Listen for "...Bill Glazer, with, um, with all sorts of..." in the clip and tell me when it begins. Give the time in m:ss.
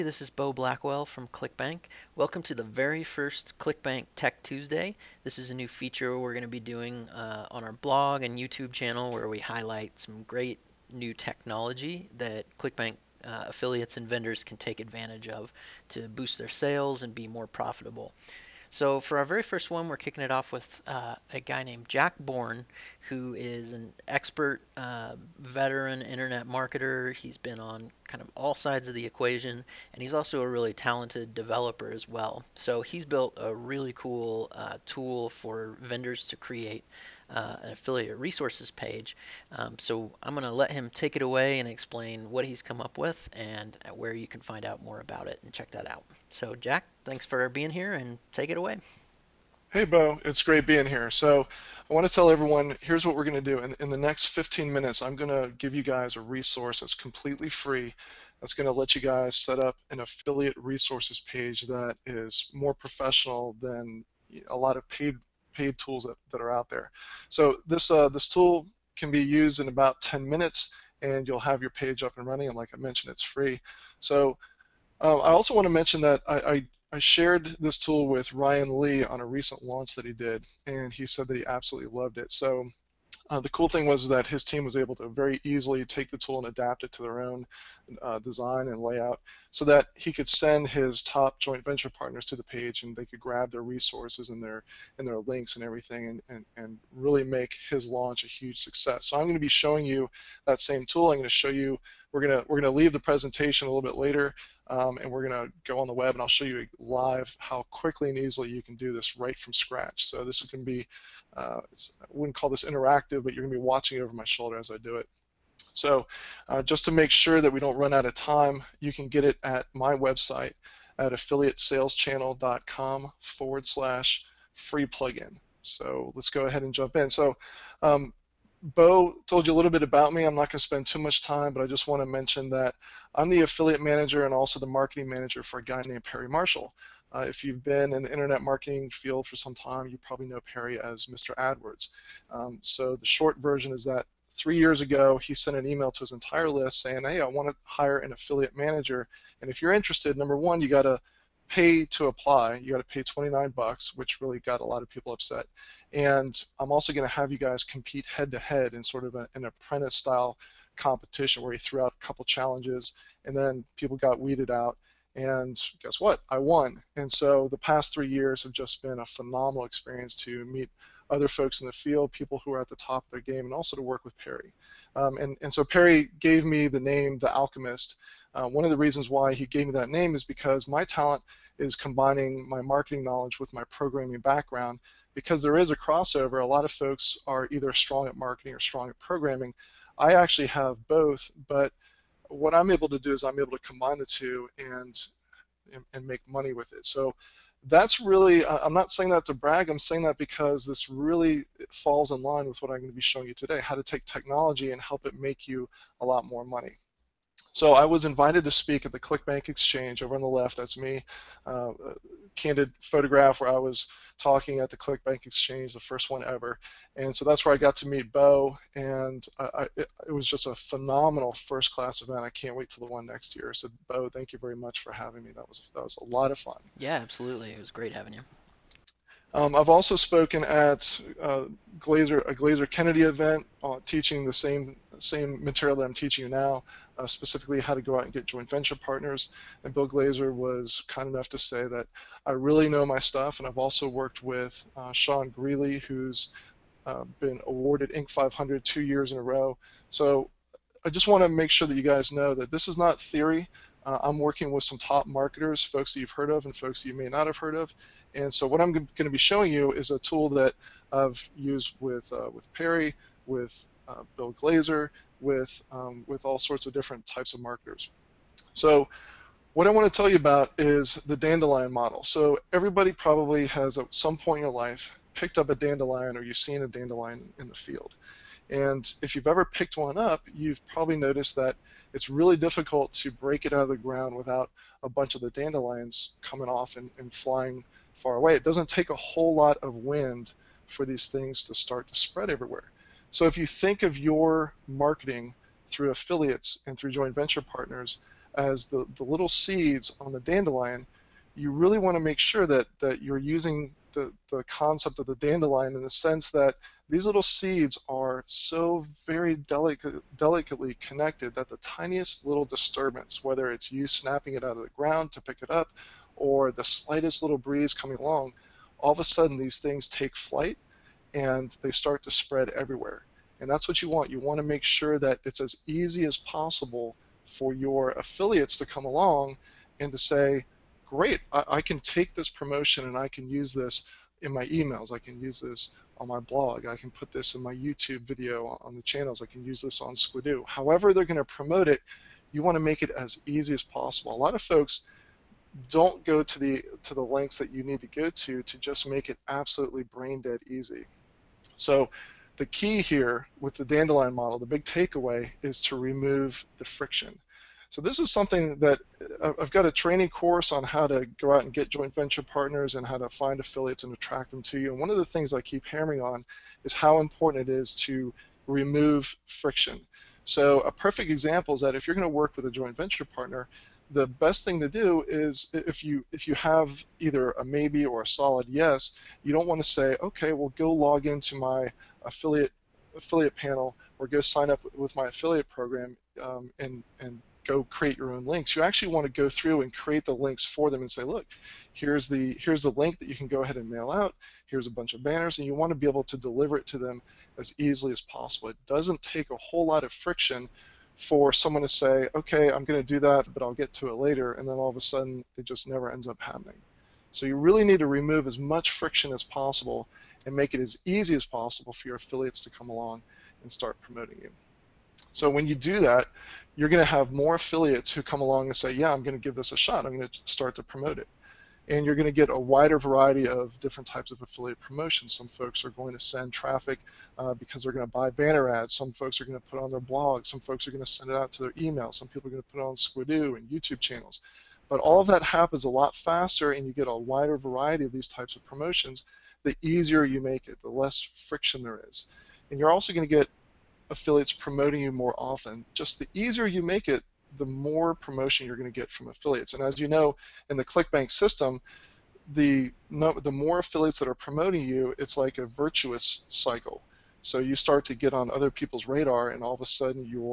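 4:24.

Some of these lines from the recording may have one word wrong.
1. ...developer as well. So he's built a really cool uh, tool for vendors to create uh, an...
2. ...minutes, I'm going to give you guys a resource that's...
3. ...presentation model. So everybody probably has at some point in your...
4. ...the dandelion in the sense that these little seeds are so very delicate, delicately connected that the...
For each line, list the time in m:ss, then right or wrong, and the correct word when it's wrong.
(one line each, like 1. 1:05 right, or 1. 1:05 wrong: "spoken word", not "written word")
1. 0:31 right
2. 0:54 right
3. 4:31 wrong: "dandelion", not "presentation"
4. 5:05 right.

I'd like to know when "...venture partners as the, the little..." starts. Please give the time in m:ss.
4:57.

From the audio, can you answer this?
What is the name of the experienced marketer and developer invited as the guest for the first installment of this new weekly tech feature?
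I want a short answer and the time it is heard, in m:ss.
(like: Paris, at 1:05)
Jack Born, at 0:21.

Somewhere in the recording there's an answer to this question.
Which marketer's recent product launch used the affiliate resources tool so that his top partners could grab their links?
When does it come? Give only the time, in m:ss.
1:18.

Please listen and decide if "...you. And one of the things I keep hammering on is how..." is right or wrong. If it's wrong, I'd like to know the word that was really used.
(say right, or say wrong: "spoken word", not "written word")
right.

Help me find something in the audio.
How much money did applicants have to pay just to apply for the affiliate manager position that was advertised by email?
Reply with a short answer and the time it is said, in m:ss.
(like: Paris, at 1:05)
29 bucks, at 2:33.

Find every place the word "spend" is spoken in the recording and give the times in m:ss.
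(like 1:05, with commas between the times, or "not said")
2:10.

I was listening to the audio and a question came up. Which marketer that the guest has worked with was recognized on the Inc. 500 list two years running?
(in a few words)
Sean Greeley.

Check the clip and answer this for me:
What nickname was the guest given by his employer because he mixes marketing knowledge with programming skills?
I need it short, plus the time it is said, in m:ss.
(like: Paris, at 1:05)
The Alchemist, at 2:57.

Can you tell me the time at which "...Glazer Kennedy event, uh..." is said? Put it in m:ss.
3:52.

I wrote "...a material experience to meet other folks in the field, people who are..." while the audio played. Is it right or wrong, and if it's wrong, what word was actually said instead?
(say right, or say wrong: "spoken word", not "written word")
wrong: "phenomenal", not "material".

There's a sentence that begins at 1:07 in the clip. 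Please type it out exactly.
So this uh, this tool can be used in about 10 minutes, and you'll have your page up and running.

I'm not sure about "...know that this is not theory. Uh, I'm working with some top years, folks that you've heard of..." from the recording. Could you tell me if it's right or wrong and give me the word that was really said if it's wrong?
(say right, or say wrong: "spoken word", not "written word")
wrong: "marketers", not "years".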